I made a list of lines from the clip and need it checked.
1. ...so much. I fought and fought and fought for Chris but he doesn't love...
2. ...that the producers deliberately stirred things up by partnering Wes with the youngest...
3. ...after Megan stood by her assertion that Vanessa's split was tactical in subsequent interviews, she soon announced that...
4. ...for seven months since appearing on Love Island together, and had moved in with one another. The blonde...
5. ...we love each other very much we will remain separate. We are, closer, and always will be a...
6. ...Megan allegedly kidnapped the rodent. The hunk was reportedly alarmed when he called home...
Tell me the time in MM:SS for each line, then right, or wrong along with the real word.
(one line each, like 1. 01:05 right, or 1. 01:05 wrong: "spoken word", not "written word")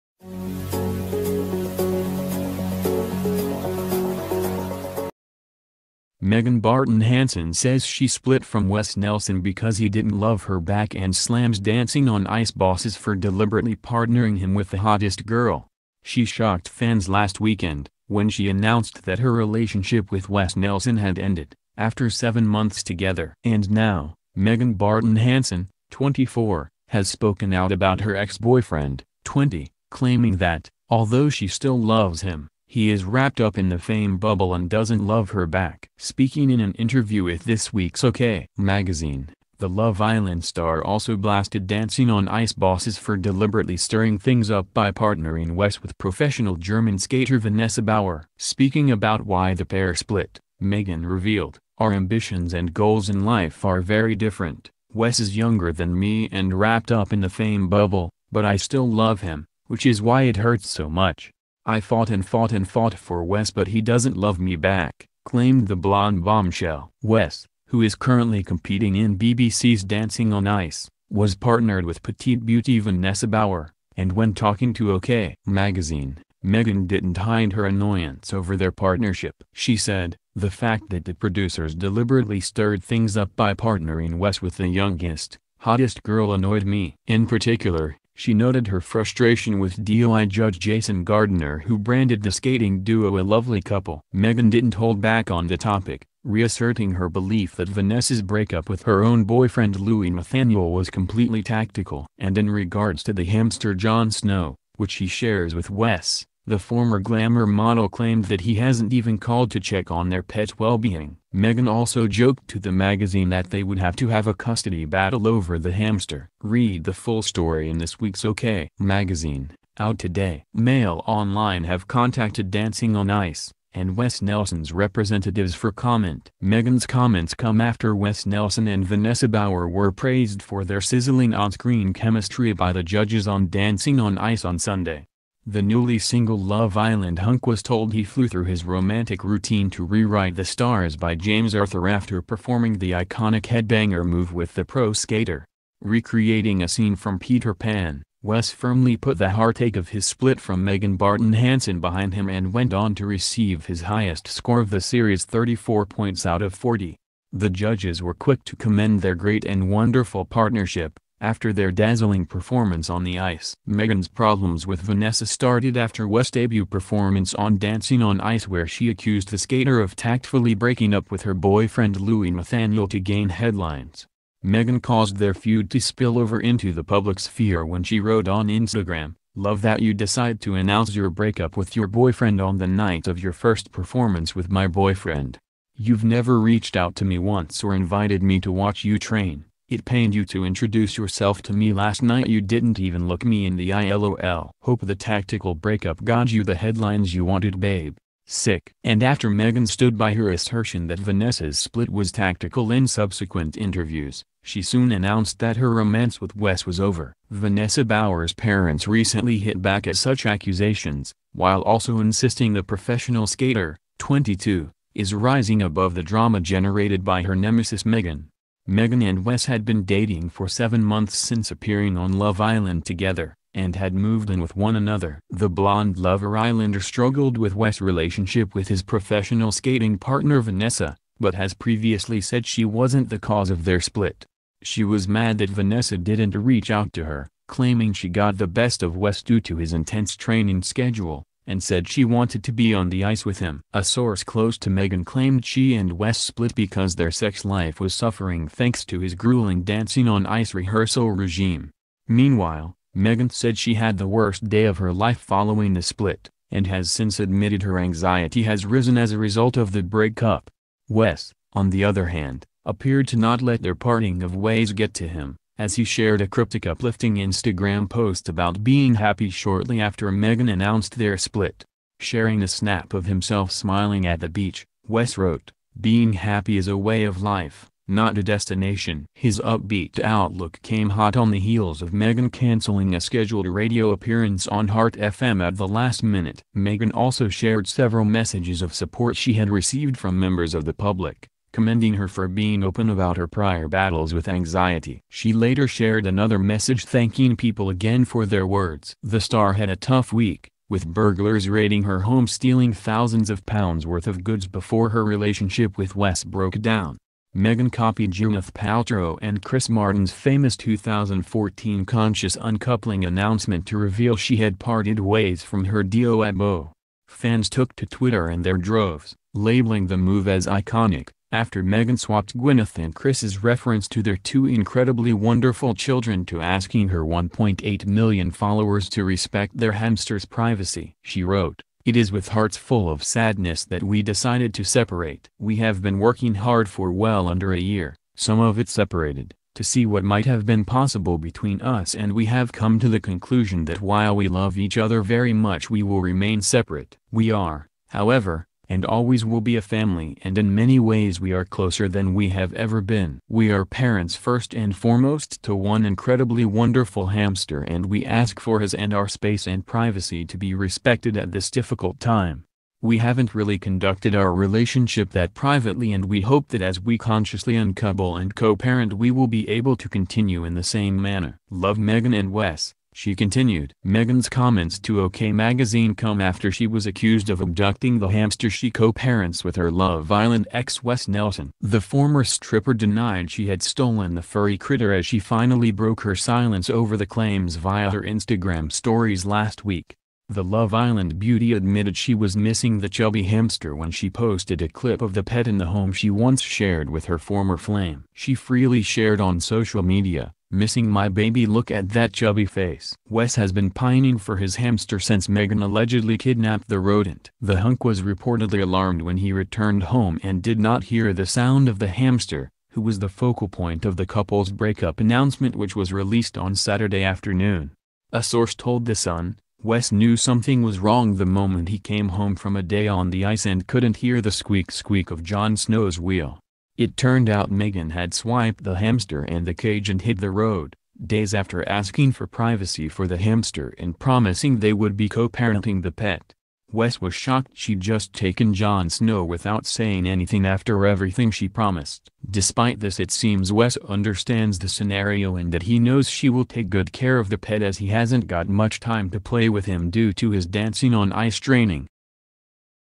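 1. 01:00 wrong: "Wes", not "Chris"
2. 01:20 right
3. 03:19 right
4. 03:40 right
5. 05:44 wrong: "however", not "closer"
6. 06:45 wrong: "returned", not "called".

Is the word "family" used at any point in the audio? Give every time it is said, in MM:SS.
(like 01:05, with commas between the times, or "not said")
05:49.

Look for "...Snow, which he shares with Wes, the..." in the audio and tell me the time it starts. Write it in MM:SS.
01:44.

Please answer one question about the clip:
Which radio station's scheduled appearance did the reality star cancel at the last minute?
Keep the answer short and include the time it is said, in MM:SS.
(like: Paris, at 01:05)
Heart FM, at 04:44.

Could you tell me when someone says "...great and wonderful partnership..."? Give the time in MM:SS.
02:39.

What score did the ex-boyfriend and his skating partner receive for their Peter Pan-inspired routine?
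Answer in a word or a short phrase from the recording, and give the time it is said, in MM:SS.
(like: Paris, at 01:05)
34 out of 40, at 02:35.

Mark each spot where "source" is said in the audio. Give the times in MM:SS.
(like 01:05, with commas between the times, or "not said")
04:03, 06:58.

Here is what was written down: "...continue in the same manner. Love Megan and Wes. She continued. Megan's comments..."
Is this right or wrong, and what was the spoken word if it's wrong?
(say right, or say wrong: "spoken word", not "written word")
right.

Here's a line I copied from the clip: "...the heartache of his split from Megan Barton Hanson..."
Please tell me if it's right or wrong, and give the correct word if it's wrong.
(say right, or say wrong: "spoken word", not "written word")
right.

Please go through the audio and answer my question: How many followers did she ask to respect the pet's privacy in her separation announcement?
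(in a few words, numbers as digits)
1.8 million.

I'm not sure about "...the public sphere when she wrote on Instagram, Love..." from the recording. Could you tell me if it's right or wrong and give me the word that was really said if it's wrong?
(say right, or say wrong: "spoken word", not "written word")
right.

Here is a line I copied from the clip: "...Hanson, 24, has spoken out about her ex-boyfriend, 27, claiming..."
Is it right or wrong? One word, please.
wrong.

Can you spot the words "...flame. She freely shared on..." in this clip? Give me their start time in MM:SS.
06:37.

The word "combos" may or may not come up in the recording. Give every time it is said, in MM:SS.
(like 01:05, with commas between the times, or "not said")
not said.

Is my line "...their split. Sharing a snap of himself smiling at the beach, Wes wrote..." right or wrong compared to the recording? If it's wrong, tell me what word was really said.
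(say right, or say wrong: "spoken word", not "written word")
right.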